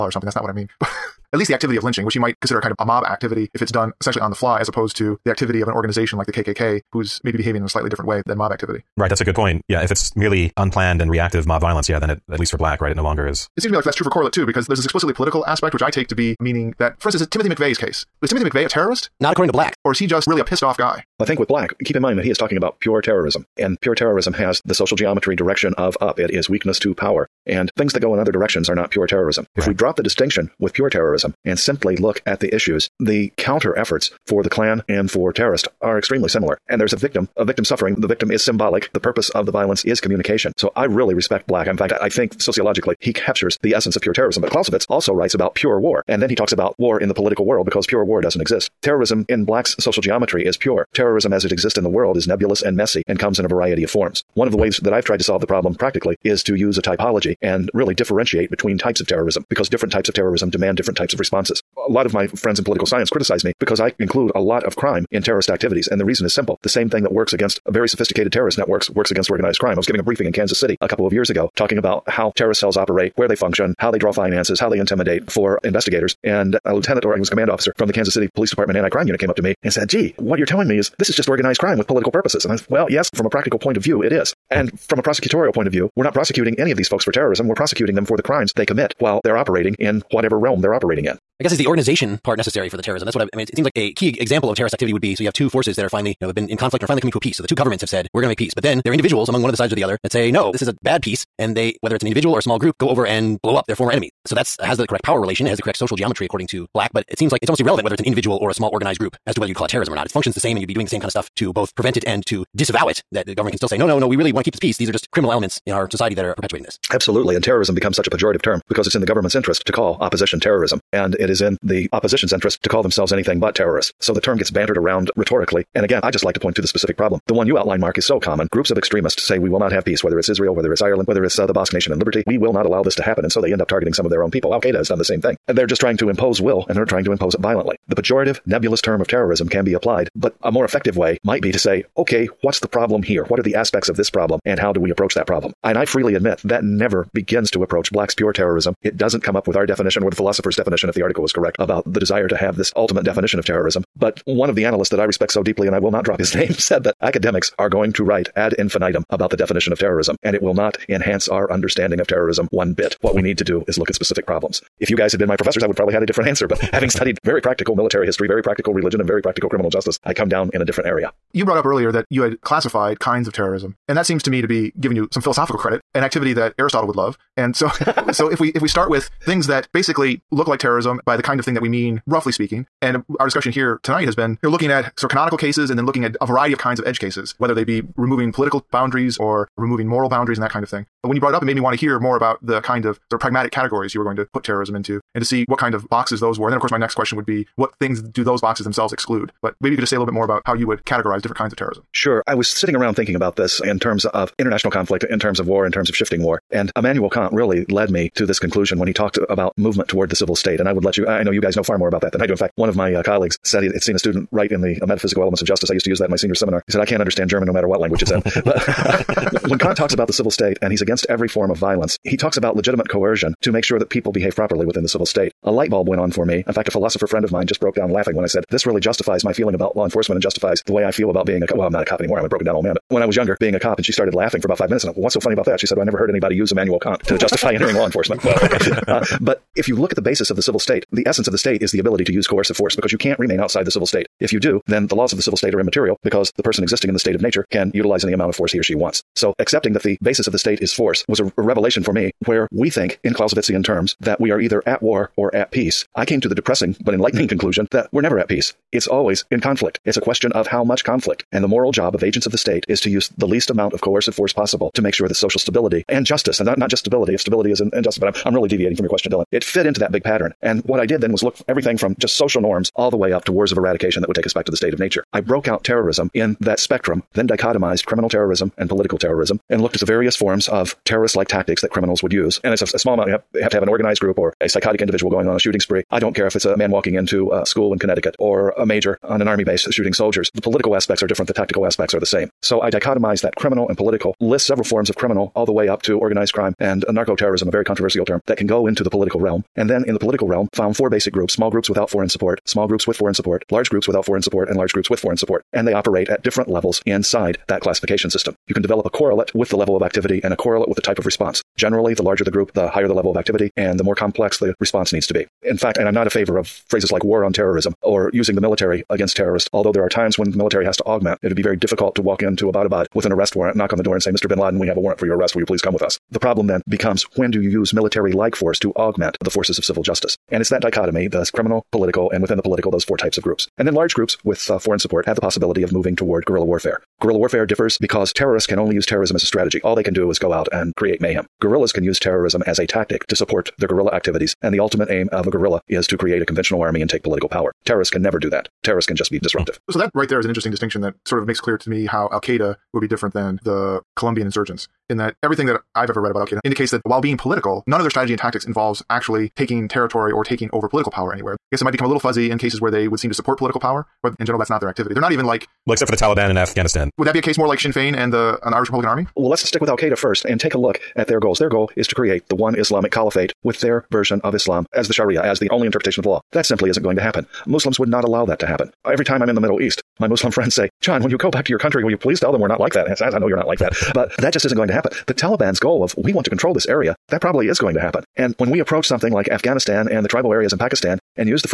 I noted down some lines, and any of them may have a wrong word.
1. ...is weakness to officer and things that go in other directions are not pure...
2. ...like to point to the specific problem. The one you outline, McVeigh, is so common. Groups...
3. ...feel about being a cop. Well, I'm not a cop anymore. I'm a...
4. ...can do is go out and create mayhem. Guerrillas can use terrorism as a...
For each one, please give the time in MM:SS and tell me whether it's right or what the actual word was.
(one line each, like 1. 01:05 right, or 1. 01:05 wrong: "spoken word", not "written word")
1. 00:26 wrong: "power", not "officer"
2. 02:06 wrong: "Mark", not "McVeigh"
3. 03:50 right
4. 05:39 right.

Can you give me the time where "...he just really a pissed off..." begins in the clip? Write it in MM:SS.
00:19.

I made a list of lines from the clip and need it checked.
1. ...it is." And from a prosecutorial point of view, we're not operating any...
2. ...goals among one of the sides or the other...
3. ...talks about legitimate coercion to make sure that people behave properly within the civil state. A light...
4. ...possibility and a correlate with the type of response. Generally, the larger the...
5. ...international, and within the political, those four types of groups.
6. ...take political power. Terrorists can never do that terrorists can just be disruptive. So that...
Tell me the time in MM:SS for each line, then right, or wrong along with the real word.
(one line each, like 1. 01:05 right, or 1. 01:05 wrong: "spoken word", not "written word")
1. 01:24 wrong: "prosecuting", not "operating"
2. 01:38 wrong: "individuals", not "goals"
3. 03:42 right
4. 05:09 wrong: "activity", not "possibility"
5. 05:31 wrong: "political", not "international"
6. 05:46 right.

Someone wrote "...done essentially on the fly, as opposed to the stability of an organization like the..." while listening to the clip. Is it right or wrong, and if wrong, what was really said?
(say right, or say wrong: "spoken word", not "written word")
wrong: "activity", not "stability".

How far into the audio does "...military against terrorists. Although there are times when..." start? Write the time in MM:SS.
05:18.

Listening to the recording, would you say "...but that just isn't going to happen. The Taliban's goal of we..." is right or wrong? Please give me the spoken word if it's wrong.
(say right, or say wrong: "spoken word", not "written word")
right.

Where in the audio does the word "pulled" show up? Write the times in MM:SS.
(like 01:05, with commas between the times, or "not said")
not said.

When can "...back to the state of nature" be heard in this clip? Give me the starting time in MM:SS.
04:34.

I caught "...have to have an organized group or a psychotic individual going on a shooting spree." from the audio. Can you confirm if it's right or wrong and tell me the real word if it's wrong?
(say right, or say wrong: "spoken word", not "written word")
right.